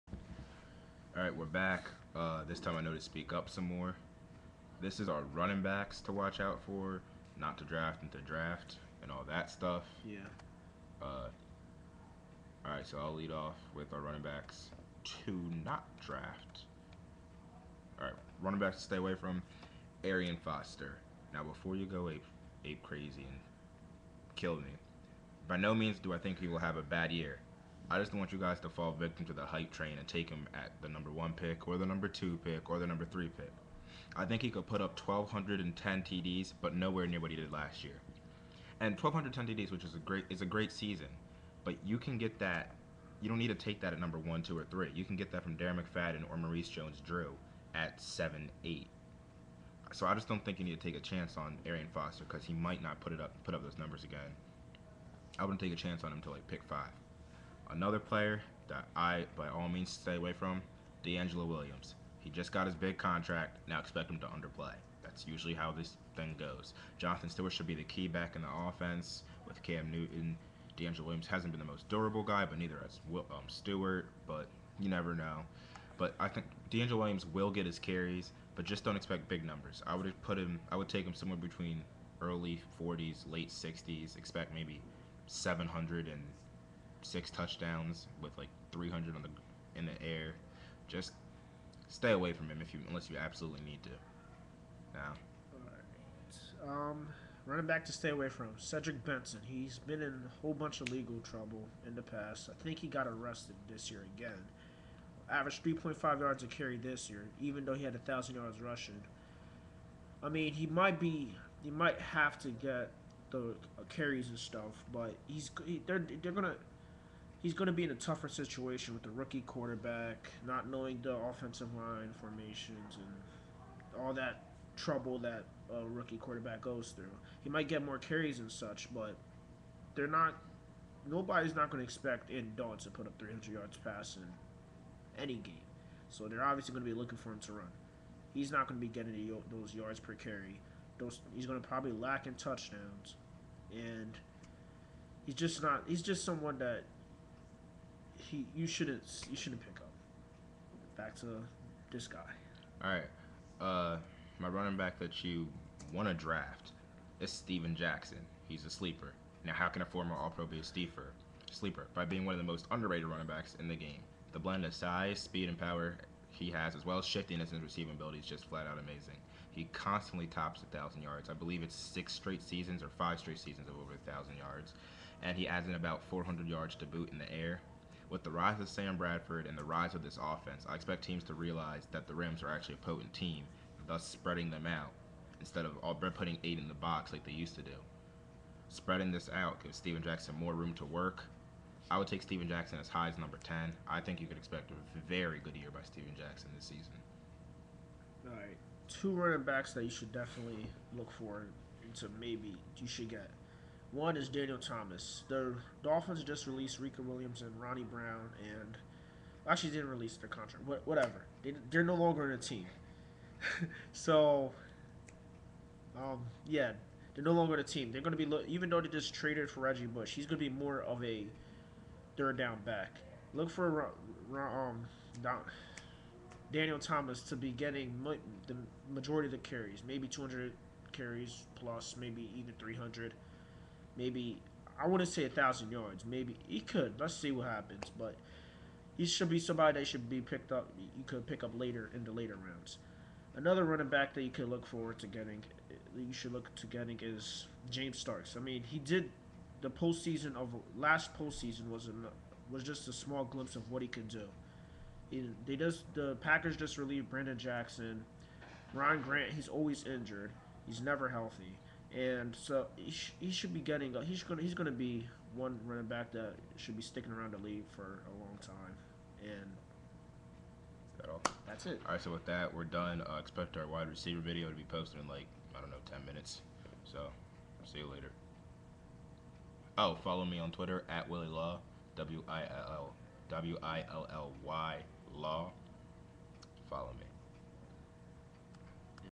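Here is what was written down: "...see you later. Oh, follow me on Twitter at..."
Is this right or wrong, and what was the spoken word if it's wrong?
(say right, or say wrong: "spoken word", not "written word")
right.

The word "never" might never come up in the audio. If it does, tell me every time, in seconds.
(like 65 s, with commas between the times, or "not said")
74 s, 260 s.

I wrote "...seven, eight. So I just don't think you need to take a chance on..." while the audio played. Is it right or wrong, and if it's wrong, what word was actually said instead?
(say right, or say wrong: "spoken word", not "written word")
right.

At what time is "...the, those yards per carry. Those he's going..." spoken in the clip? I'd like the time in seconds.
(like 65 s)
139 s.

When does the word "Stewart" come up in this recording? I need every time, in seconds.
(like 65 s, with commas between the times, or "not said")
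67 s, 73 s.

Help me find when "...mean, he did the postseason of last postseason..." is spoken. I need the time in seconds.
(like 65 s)
248 s.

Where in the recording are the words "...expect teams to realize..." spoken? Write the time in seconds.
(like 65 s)
180 s.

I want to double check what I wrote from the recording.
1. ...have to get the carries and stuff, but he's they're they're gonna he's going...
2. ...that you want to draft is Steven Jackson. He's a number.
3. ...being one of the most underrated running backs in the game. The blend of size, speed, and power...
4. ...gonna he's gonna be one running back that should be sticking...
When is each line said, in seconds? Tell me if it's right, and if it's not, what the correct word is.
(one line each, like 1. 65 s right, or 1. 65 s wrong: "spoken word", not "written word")
1. 111 s right
2. 154 s wrong: "sleeper", not "number"
3. 162 s right
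4. 264 s right.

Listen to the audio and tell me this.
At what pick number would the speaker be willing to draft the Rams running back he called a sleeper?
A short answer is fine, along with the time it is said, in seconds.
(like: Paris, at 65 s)
10, at 193 s.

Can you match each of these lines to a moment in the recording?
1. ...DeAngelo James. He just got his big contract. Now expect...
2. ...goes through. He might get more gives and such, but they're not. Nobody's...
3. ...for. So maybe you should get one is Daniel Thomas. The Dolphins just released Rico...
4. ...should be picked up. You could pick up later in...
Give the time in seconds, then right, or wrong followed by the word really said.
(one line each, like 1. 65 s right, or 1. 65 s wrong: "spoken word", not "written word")
1. 61 s wrong: "Williams", not "James"
2. 126 s wrong: "carries", not "gives"
3. 201 s right
4. 239 s right.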